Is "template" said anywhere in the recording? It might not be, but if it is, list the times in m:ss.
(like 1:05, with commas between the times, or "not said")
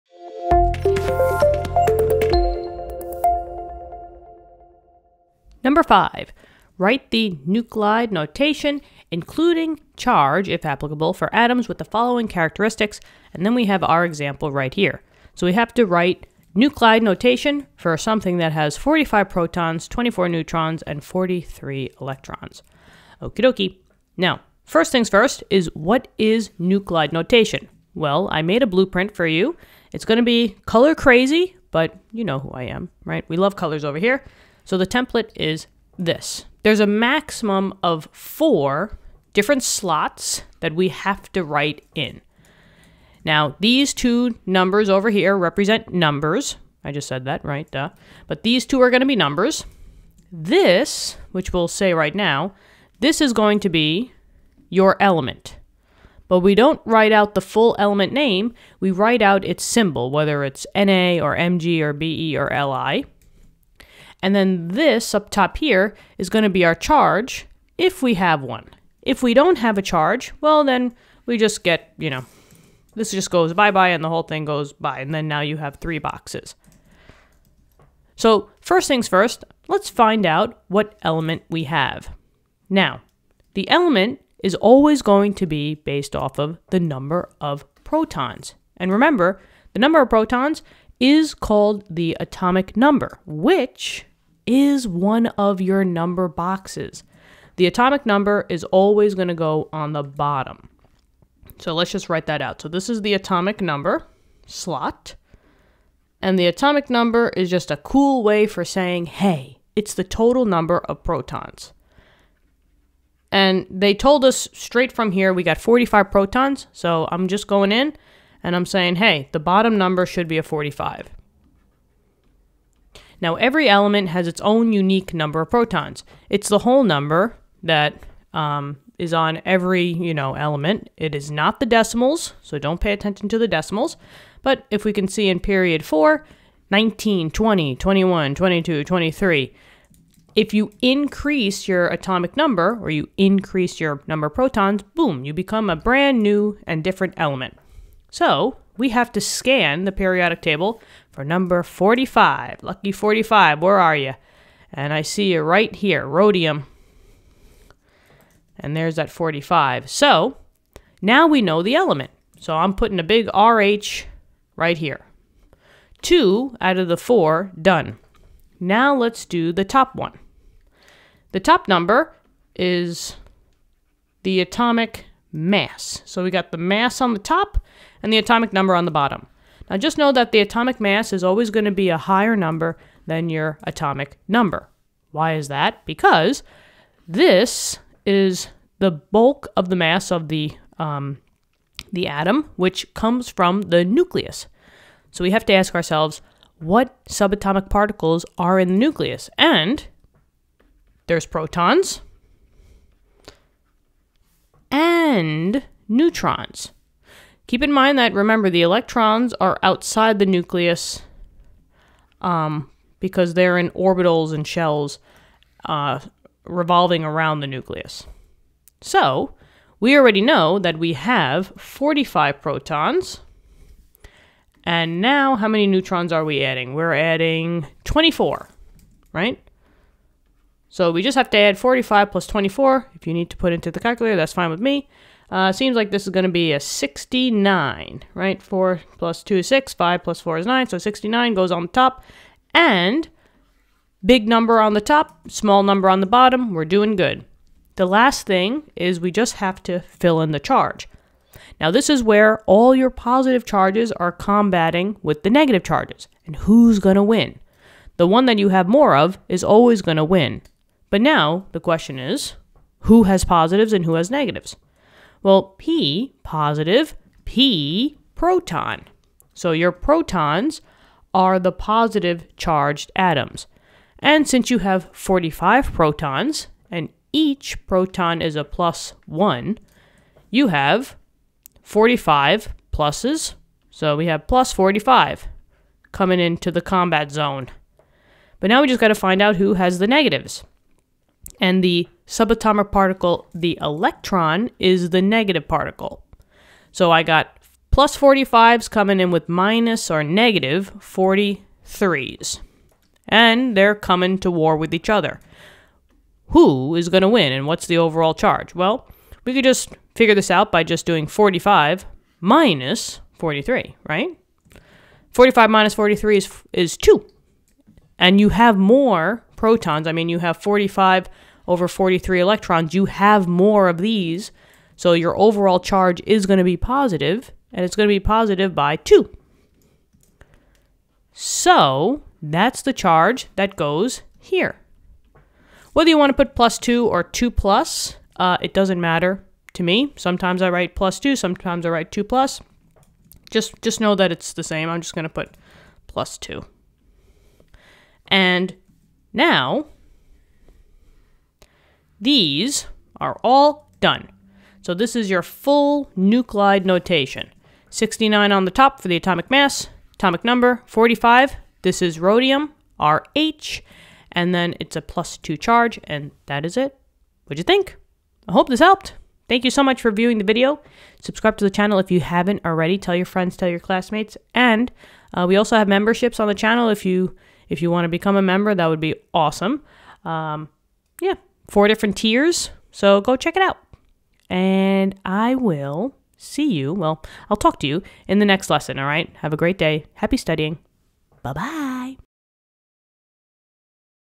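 0:34.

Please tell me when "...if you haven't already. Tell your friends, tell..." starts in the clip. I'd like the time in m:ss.
6:11.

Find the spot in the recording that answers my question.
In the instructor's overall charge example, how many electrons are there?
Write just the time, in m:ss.
5:00.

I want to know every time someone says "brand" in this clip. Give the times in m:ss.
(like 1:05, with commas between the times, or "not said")
2:25.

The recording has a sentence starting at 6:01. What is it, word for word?
This is rhodium, RH, and then it's a plus 2 charge, and that is it.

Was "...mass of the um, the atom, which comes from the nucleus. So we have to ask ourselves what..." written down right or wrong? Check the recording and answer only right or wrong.
right.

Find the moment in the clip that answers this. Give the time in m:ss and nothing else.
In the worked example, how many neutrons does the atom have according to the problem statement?
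0:19.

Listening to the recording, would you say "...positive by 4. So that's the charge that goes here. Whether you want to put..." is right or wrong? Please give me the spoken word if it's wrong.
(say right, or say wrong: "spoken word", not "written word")
wrong: "2", not "4".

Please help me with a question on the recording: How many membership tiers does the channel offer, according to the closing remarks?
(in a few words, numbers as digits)
4.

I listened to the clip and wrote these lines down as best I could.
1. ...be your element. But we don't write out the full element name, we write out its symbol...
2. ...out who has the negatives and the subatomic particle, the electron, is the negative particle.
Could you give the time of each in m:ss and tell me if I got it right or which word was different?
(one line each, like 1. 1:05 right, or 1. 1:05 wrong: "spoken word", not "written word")
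1. 0:53 right
2. 4:49 right.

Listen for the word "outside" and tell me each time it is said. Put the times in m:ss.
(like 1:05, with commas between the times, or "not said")
3:29.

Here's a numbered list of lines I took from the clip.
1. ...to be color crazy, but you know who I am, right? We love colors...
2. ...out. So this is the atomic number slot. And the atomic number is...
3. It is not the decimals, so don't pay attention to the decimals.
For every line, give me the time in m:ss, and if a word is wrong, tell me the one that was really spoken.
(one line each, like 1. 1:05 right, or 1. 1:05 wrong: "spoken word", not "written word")
1. 0:30 right
2. 1:42 right
3. 2:10 right.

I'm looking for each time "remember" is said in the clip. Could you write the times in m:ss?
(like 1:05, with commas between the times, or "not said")
1:28, 3:28.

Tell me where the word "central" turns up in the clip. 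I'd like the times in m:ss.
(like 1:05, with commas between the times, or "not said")
not said.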